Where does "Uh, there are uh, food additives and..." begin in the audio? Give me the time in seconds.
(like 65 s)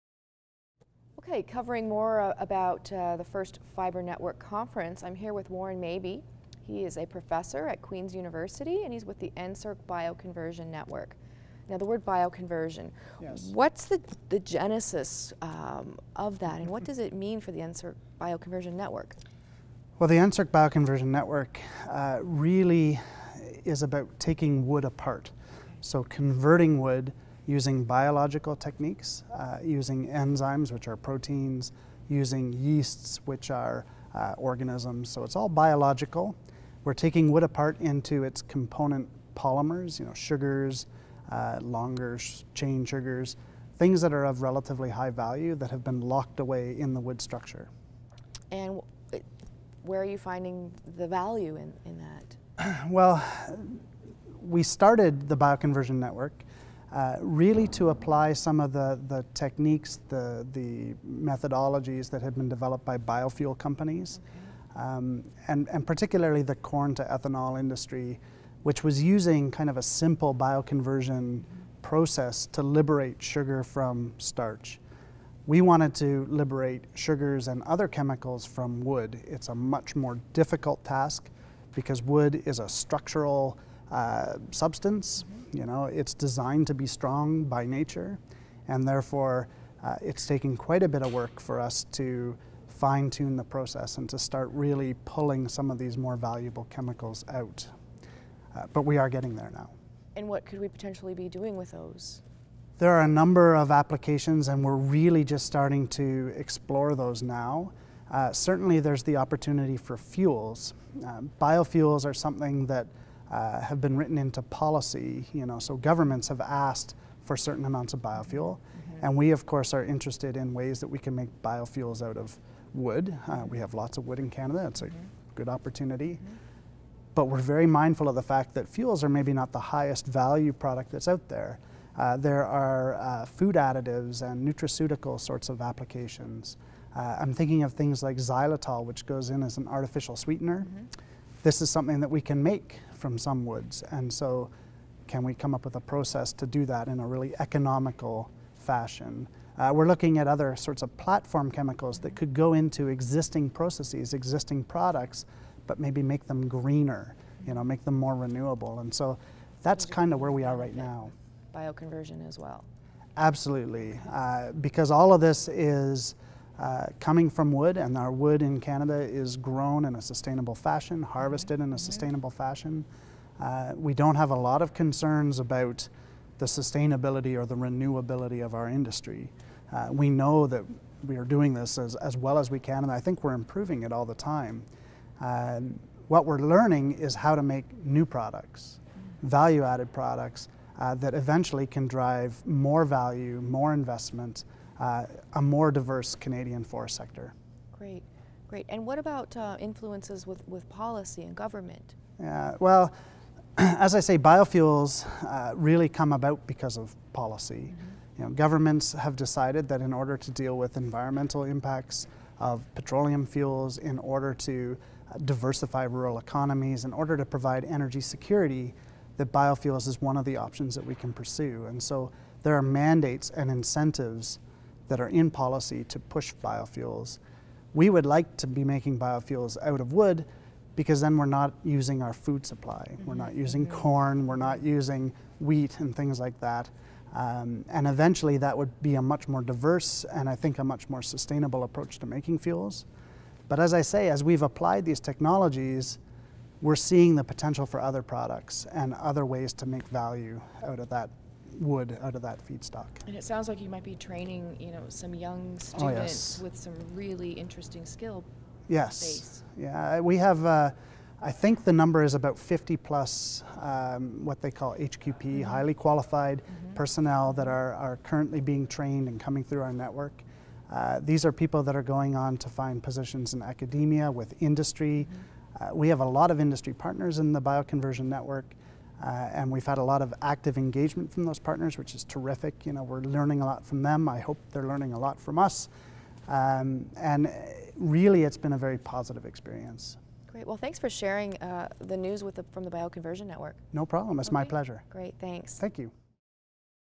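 131 s.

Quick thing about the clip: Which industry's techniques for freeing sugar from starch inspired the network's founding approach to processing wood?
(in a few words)
corn to ethanol.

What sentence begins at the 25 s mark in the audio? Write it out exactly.
So, converting wood using biological techniques, uh, using enzymes, which are proteins, using yeasts, which are uh, organisms.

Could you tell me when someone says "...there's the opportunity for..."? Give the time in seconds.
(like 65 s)
108 s.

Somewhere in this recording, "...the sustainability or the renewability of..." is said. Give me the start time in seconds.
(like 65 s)
176 s.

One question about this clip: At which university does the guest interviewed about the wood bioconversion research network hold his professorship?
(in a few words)
Queen's University.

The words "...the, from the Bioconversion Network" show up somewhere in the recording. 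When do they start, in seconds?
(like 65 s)
292 s.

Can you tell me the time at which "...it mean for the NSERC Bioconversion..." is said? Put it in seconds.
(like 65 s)
16 s.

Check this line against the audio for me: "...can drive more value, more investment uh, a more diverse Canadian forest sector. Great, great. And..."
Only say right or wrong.
right.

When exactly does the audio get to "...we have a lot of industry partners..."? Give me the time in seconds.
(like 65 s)
275 s.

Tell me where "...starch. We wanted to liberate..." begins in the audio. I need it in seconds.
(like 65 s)
74 s.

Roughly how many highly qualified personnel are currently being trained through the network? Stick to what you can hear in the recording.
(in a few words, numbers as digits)
50+.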